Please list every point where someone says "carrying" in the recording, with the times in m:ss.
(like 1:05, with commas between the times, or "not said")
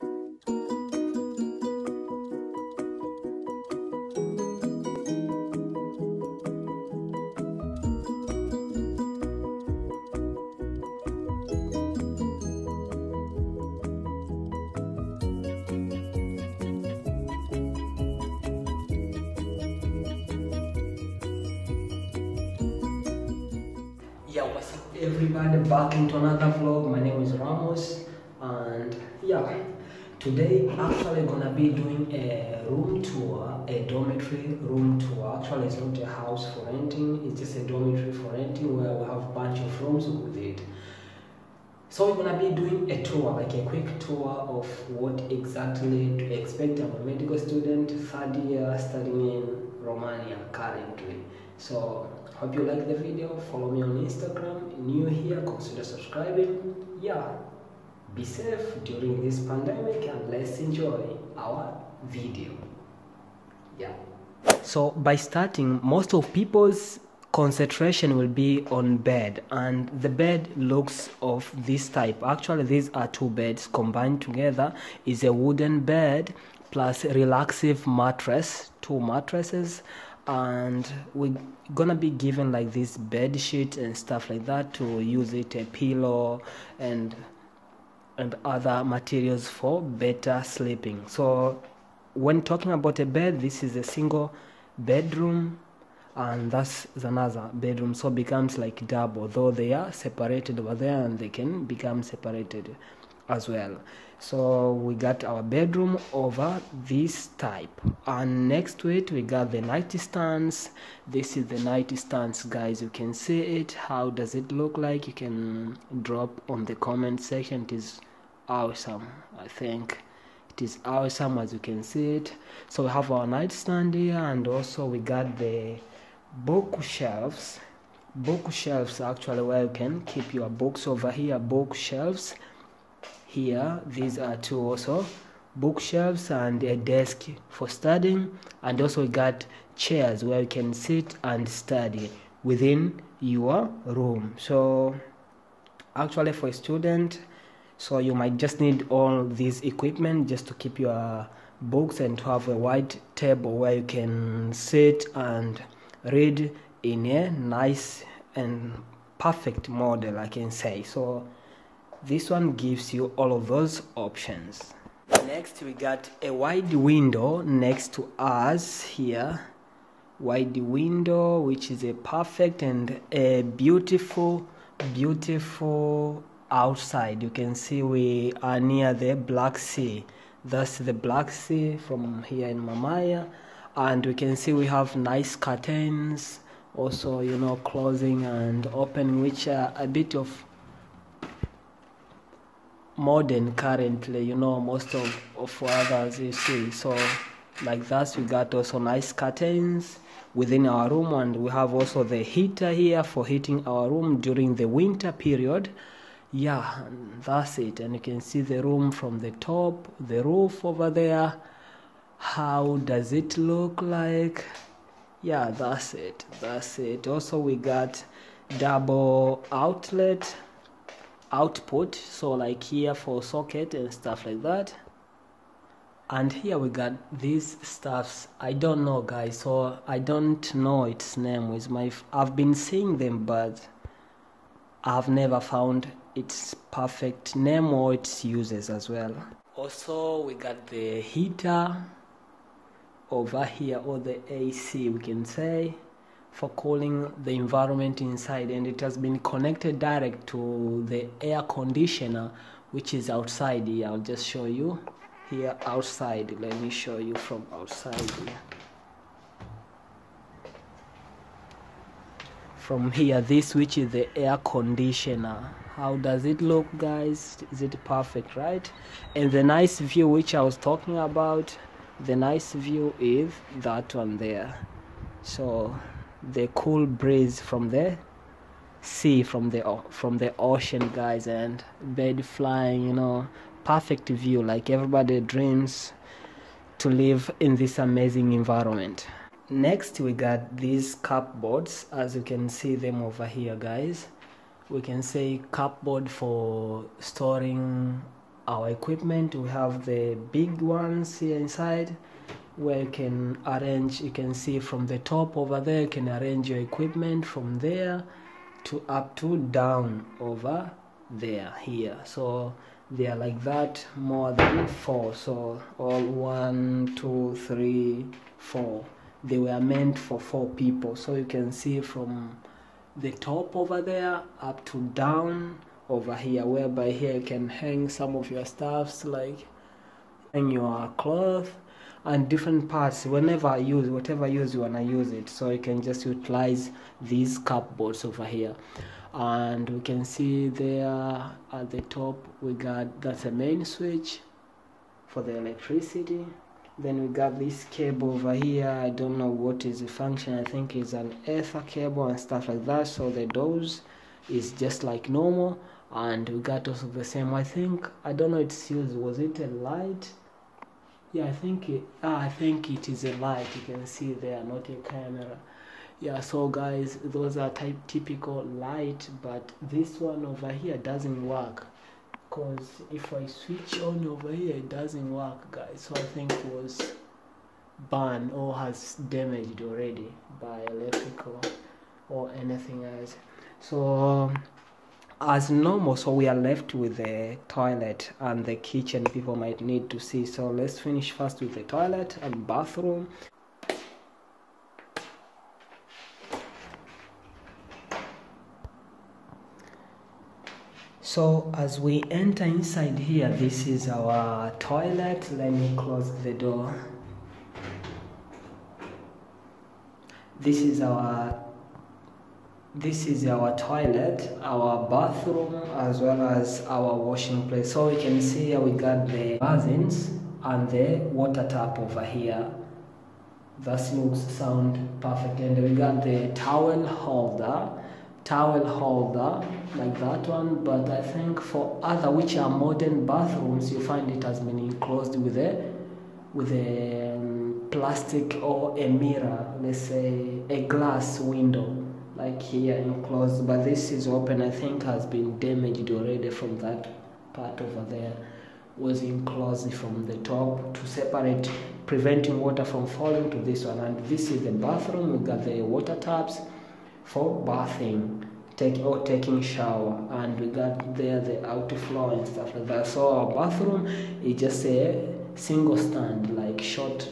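not said.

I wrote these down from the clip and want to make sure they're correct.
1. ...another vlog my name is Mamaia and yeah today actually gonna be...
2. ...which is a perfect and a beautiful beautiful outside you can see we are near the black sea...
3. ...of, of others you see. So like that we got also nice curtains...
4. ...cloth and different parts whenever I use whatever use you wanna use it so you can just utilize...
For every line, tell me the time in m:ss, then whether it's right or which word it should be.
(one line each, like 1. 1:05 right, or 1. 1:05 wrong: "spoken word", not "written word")
1. 0:26 wrong: "Ramose", not "Mamaia"
2. 2:51 right
3. 3:14 right
4. 5:30 right.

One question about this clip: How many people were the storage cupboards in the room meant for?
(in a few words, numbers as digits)
4.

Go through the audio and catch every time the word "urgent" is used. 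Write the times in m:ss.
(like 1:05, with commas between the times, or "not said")
not said.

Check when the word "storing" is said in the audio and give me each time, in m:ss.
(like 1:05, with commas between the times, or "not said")
4:56.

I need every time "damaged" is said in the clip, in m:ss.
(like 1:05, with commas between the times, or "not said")
6:19, 7:25.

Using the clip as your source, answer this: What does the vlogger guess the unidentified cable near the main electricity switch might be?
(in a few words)
Ether cable.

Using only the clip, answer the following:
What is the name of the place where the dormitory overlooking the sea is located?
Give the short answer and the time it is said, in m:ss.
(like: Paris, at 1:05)
Mamaia, at 3:02.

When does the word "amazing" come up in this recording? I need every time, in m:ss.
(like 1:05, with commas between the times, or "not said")
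4:47.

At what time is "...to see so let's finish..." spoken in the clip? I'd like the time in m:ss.
6:29.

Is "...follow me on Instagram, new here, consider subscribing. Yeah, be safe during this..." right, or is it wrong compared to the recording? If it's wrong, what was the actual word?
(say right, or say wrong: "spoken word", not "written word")
right.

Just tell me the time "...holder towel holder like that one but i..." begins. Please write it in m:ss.
7:06.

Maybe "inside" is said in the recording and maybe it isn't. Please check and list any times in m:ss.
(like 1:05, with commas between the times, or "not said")
4:08, 5:01, 6:42.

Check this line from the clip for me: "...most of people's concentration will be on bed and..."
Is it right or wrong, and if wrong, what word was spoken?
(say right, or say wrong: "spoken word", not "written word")
right.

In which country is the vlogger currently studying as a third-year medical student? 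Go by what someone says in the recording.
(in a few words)
Romania.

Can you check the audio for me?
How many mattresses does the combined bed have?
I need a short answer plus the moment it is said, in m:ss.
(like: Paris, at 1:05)
2, at 1:18.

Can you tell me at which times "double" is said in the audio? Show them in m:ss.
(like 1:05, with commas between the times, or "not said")
1:38, 3:38.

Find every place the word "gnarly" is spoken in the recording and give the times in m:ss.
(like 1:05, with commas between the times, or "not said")
not said.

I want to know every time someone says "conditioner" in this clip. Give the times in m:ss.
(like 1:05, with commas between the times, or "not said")
4:11, 4:24.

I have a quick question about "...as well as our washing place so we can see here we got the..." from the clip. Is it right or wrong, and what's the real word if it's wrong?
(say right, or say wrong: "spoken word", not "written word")
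right.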